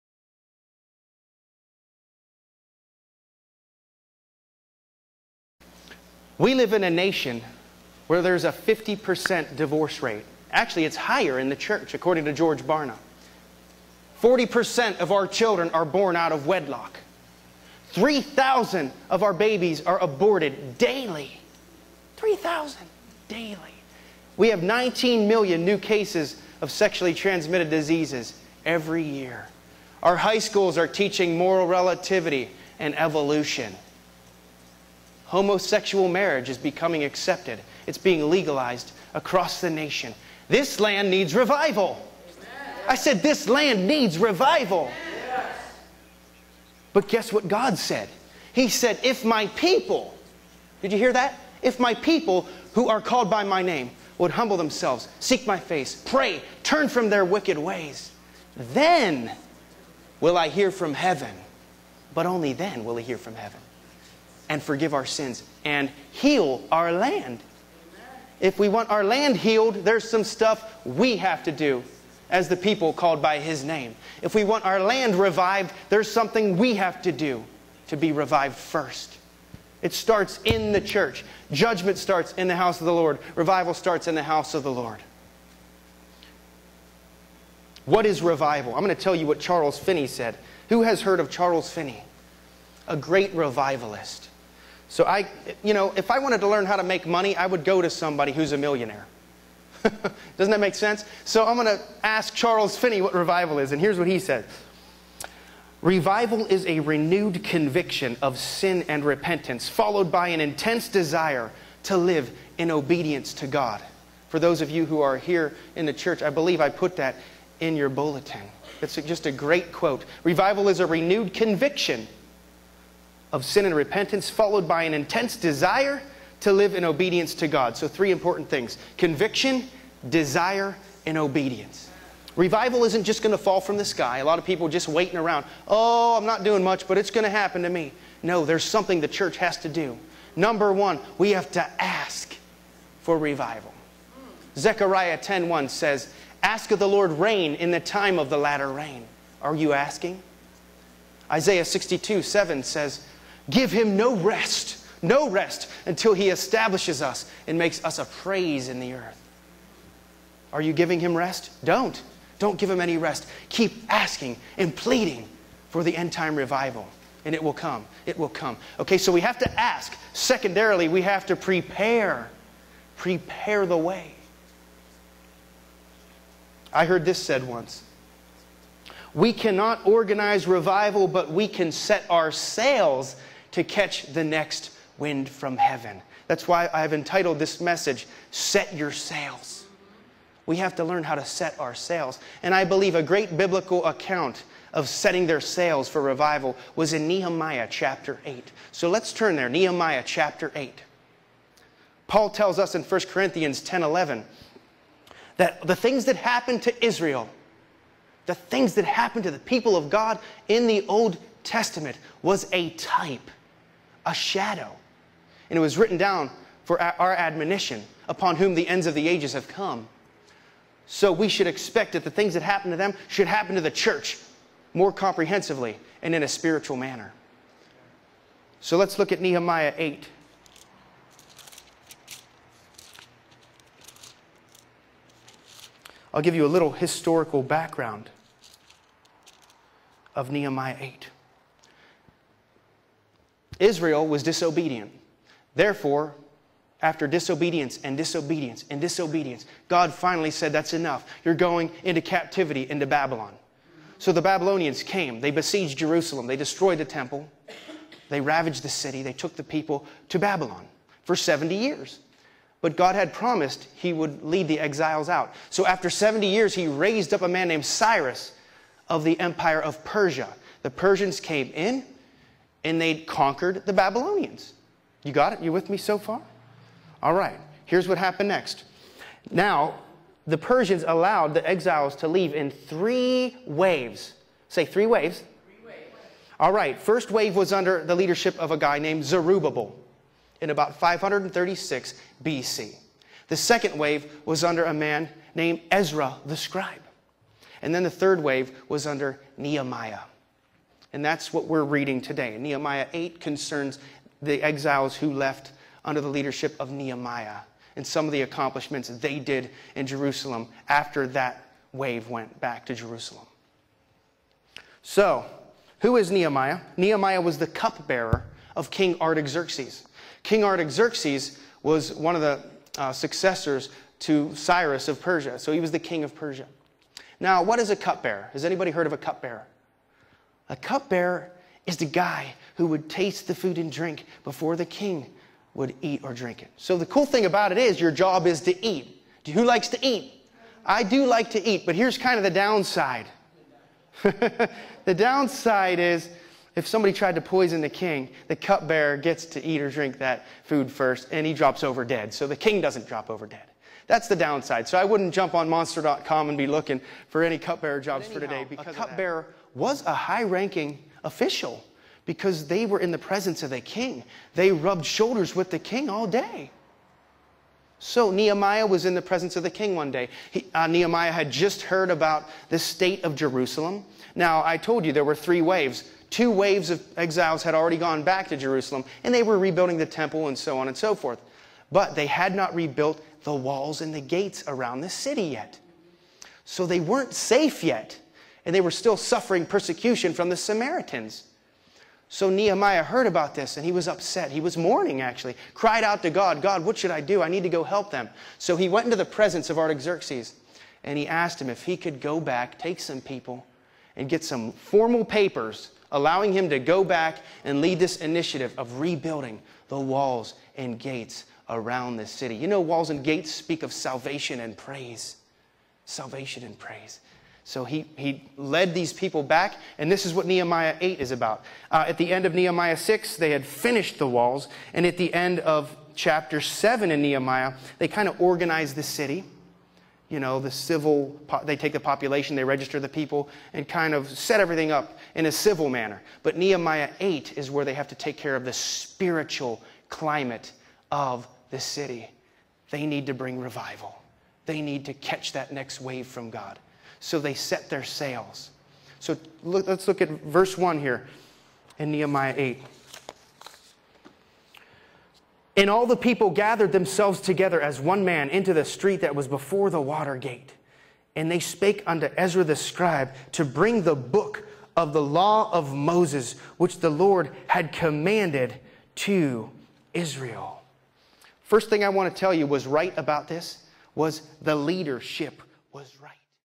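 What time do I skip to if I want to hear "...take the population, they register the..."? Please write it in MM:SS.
07:11.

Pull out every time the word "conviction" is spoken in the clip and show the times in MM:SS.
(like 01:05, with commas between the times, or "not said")
01:47, 02:01, 02:08.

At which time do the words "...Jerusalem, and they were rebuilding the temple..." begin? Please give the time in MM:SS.
06:18.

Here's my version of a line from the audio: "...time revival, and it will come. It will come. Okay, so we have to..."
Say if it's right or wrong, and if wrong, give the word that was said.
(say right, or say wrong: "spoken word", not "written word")
right.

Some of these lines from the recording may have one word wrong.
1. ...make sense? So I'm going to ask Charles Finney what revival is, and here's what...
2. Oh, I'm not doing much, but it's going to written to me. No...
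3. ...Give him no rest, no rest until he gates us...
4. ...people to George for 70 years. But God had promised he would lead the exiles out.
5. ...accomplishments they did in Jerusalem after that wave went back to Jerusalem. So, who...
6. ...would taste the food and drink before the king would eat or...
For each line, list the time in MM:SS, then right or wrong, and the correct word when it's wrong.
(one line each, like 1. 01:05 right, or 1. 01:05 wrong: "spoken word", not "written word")
1. 01:40 right
2. 02:15 wrong: "happen", not "written"
3. 02:33 wrong: "establishes", not "gates"
4. 04:19 wrong: "Babylon", not "George"
5. 05:08 right
6. 05:32 right.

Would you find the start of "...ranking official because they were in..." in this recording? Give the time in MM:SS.
06:00.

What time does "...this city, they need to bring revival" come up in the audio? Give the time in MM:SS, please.
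07:21.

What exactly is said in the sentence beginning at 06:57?
So he, he led these people back, and this is what Nehemiah 8 is about.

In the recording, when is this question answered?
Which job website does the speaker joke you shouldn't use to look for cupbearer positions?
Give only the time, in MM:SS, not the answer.
05:55.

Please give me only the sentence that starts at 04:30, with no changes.
The Persians came in and they conquered the Babylonians.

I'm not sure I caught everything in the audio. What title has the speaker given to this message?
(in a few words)
Set Your Sails.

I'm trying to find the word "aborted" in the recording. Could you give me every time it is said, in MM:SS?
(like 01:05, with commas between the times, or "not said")
00:20.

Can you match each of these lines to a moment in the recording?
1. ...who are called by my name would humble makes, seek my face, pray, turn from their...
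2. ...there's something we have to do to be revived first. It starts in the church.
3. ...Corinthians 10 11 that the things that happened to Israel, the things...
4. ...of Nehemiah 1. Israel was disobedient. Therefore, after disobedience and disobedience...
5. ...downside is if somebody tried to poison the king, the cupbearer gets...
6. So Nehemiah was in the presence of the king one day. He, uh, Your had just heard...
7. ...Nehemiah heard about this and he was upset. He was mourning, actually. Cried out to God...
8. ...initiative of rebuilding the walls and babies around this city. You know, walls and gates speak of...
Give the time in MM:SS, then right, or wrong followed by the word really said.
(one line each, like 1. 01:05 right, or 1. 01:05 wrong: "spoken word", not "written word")
1. 00:52 wrong: "themselves", not "makes"
2. 01:15 right
3. 03:23 right
4. 04:00 wrong: "8", not "1"
5. 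05:44 right
6. 06:07 wrong: "Nehemiah", not "Your"
7. 06:32 right
8. 06:47 wrong: "gates", not "babies".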